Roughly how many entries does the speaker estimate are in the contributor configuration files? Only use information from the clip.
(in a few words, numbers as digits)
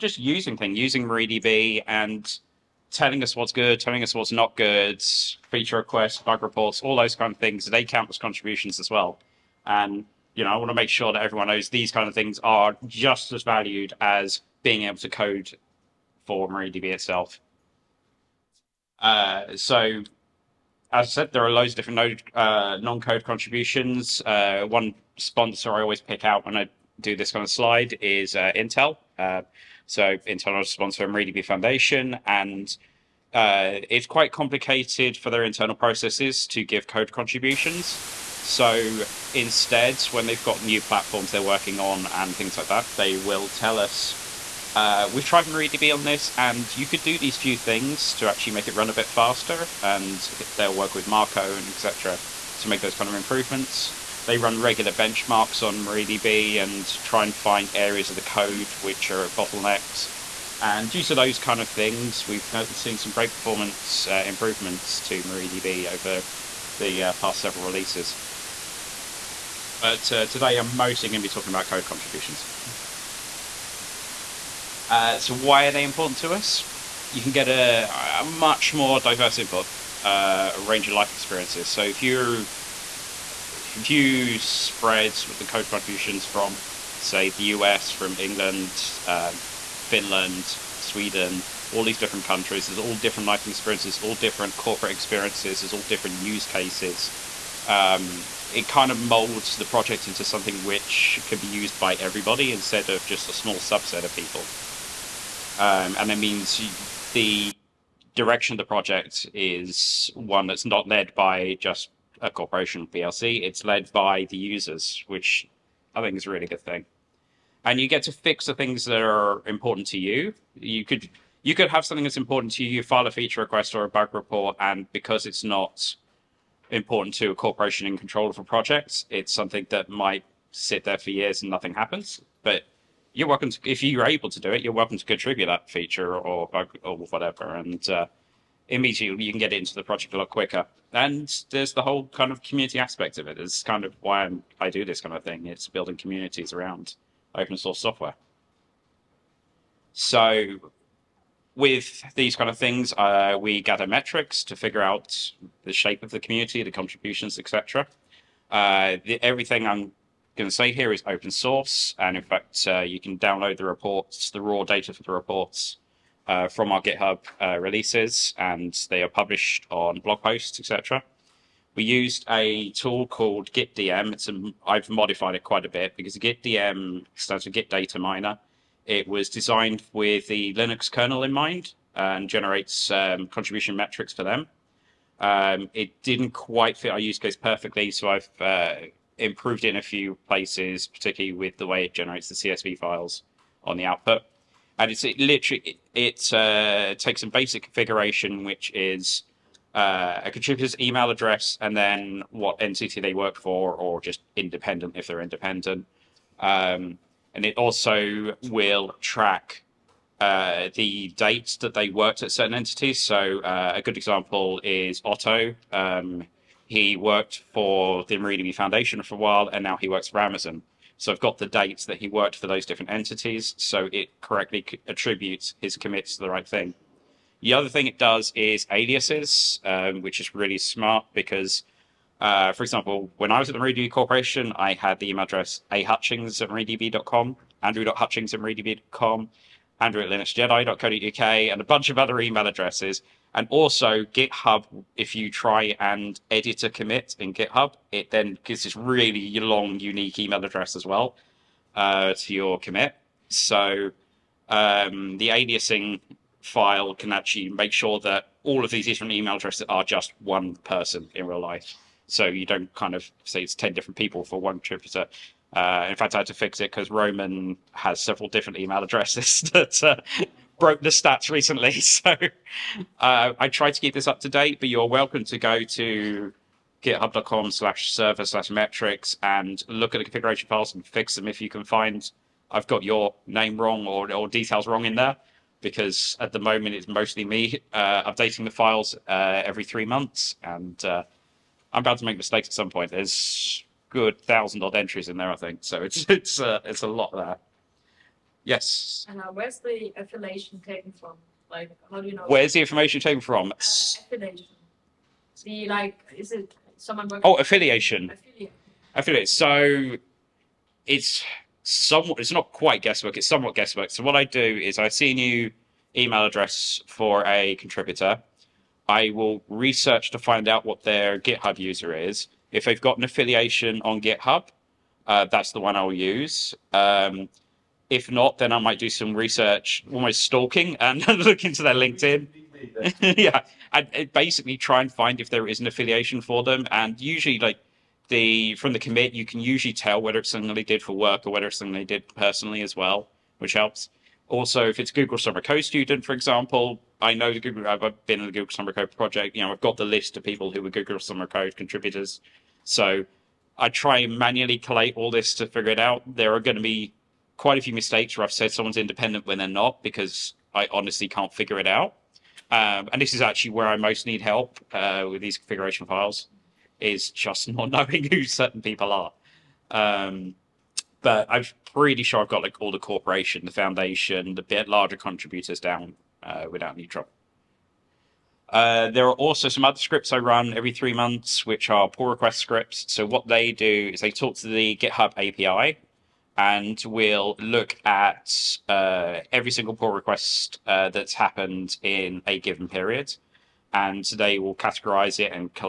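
thousand.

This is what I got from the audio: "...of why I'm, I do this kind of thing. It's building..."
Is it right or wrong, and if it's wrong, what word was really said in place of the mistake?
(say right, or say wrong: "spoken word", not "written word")
right.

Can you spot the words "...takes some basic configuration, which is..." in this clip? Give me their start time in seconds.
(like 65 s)
196 s.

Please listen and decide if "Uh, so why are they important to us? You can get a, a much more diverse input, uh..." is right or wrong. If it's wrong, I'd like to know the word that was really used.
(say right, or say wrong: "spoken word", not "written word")
right.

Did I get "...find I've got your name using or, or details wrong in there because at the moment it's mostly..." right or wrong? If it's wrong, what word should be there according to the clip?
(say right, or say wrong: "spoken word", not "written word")
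wrong: "wrong", not "using".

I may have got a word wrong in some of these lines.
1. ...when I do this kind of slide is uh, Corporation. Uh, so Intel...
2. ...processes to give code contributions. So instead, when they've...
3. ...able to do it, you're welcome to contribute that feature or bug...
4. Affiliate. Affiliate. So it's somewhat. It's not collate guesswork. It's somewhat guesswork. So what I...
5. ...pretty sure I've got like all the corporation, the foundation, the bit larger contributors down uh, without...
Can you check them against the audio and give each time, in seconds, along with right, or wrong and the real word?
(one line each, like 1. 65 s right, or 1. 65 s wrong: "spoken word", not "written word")
1. 26 s wrong: "Intel", not "Corporation"
2. 35 s right
3. 134 s right
4. 308 s wrong: "quite", not "collate"
5. 371 s right.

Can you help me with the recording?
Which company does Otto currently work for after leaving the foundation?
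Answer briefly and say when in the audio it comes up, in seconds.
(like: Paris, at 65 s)
Amazon, at 220 s.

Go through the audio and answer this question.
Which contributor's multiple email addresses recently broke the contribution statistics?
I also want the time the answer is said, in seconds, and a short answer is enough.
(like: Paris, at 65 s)
Roman, at 266 s.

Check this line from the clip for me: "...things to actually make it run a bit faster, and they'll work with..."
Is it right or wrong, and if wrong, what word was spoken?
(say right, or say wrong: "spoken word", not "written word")
right.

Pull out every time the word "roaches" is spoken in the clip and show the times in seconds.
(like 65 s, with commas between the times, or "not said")
not said.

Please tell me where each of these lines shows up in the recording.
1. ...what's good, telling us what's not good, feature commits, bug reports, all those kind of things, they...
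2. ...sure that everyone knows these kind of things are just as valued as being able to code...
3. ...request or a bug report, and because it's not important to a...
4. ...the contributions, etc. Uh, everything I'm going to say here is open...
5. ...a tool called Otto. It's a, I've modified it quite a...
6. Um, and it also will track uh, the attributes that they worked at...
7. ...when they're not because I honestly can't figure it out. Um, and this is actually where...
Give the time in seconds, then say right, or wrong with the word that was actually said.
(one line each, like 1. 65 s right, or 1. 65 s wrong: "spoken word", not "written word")
1. 3 s wrong: "requests", not "commits"
2. 10 s right
3. 123 s right
4. 156 s right
5. 172 s wrong: "GitDM", not "Otto"
6. 206 s wrong: "dates", not "attributes"
7. 359 s right.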